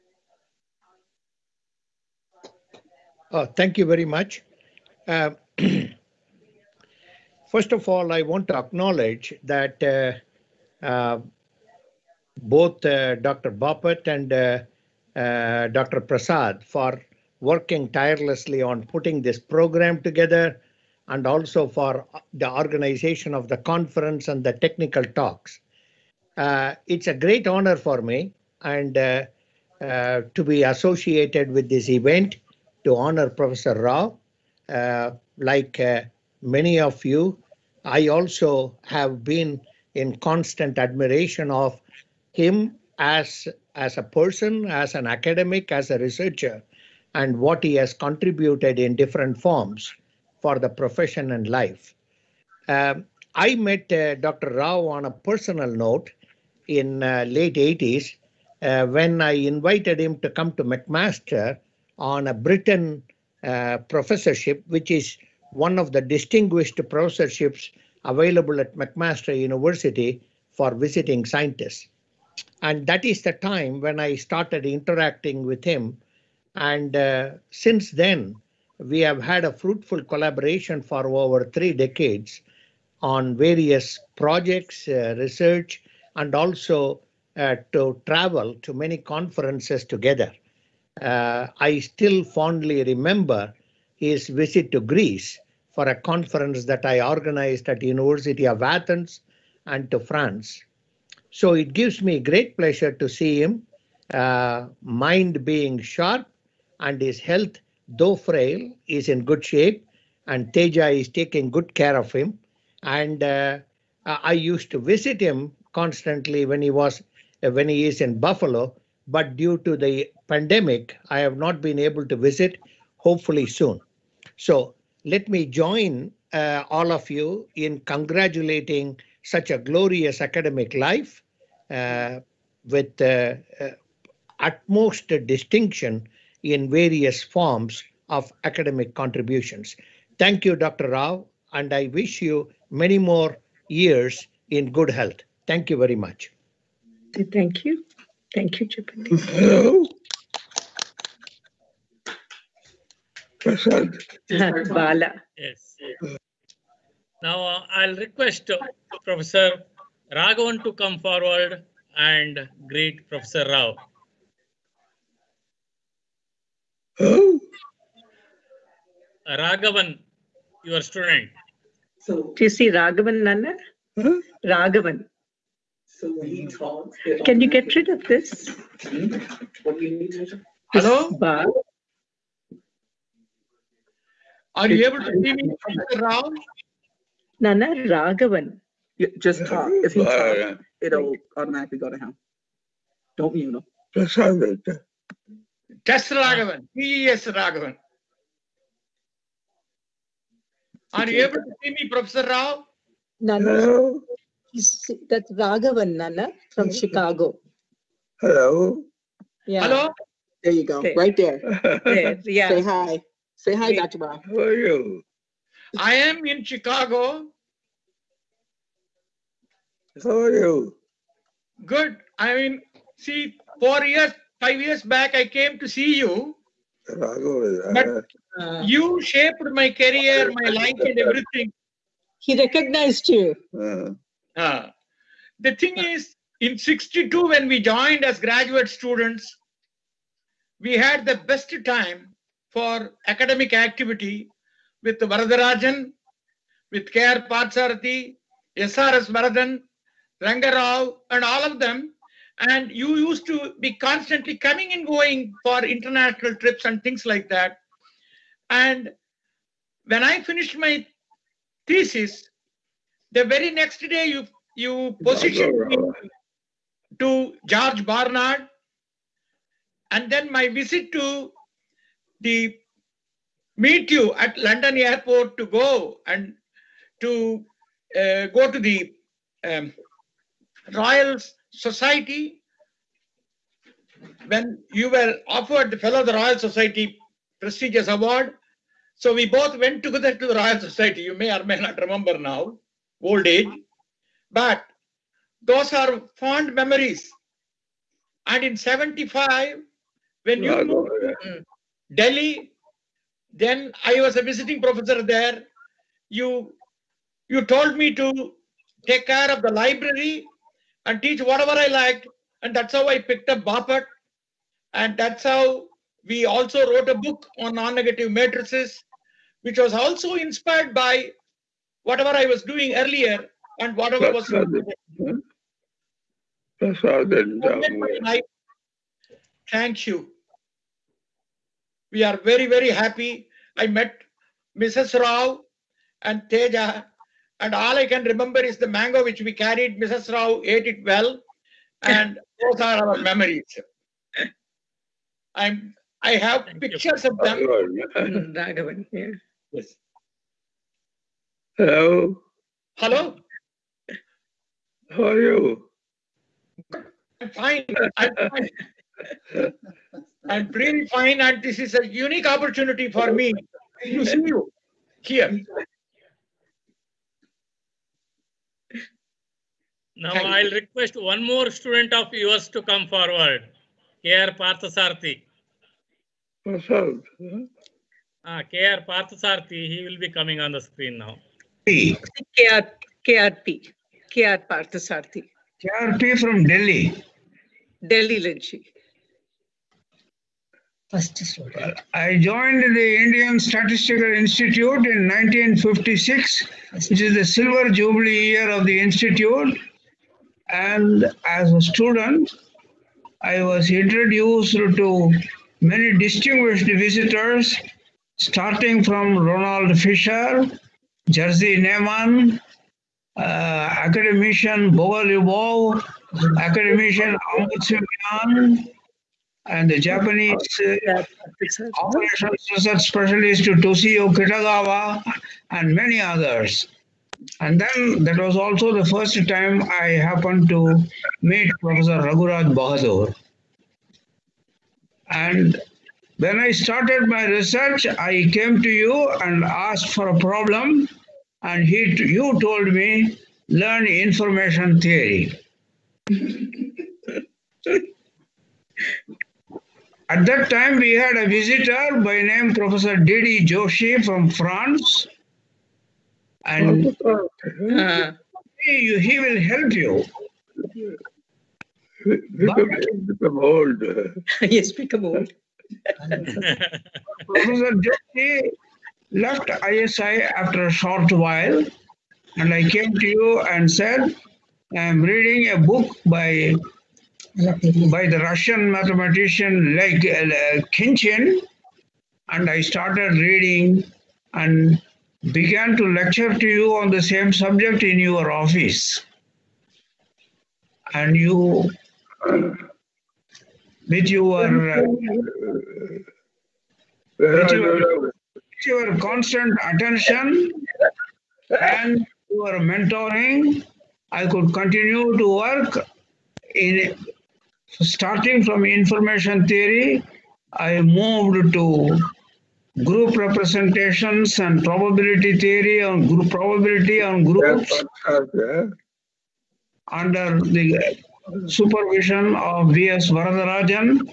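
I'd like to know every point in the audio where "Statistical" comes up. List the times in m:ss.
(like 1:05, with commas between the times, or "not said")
6:33.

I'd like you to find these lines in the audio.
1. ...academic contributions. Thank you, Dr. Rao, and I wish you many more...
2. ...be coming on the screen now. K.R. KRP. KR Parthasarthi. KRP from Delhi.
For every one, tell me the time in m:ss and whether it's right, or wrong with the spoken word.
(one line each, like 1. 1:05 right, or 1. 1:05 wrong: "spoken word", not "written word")
1. 2:18 right
2. 6:19 right.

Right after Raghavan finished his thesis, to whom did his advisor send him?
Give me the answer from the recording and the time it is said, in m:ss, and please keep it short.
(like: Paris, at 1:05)
George Barnard, at 4:27.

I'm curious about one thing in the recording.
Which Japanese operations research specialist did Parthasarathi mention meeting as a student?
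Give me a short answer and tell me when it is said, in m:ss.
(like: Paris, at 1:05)
Toshio Kitagawa, at 7:03.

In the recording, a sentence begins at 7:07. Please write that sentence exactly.
And then that was also the first time I happened to meet Professor Raghuraj Bahadur.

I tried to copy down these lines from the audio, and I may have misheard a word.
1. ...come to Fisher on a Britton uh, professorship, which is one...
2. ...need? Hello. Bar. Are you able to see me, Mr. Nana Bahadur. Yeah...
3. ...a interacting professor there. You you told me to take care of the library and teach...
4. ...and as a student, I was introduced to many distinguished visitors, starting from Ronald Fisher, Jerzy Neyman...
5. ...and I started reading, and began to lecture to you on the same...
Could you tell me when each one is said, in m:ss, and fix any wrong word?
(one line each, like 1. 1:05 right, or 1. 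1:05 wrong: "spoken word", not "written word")
1. 1:00 wrong: "McMaster", not "Fisher"
2. 2:59 wrong: "Raghavan", not "Bahadur"
3. 5:04 wrong: "visiting", not "interacting"
4. 6:40 right
5. 8:02 right.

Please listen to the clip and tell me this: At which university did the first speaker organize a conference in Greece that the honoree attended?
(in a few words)
University of Athens.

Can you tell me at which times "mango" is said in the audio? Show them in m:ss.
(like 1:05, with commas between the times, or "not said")
5:38.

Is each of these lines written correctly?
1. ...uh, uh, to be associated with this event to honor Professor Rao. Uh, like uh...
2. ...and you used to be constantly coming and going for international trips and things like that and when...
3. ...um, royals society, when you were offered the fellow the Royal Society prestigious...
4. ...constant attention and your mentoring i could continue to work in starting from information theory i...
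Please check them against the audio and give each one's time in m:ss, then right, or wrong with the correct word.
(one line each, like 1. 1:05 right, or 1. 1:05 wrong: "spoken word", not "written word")
1. 0:28 right
2. 4:12 right
3. 4:39 right
4. 8:18 right.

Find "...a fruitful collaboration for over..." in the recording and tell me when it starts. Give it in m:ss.
1:19.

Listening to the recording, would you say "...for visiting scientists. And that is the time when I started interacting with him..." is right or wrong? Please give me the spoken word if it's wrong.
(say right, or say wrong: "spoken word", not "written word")
right.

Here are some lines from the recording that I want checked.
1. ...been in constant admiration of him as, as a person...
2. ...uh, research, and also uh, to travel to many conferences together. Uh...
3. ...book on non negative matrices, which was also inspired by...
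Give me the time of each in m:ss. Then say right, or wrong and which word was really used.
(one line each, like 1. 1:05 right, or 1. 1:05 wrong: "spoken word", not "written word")
1. 0:39 right
2. 1:24 right
3. 5:16 right.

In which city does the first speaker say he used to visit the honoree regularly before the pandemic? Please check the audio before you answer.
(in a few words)
Buffalo.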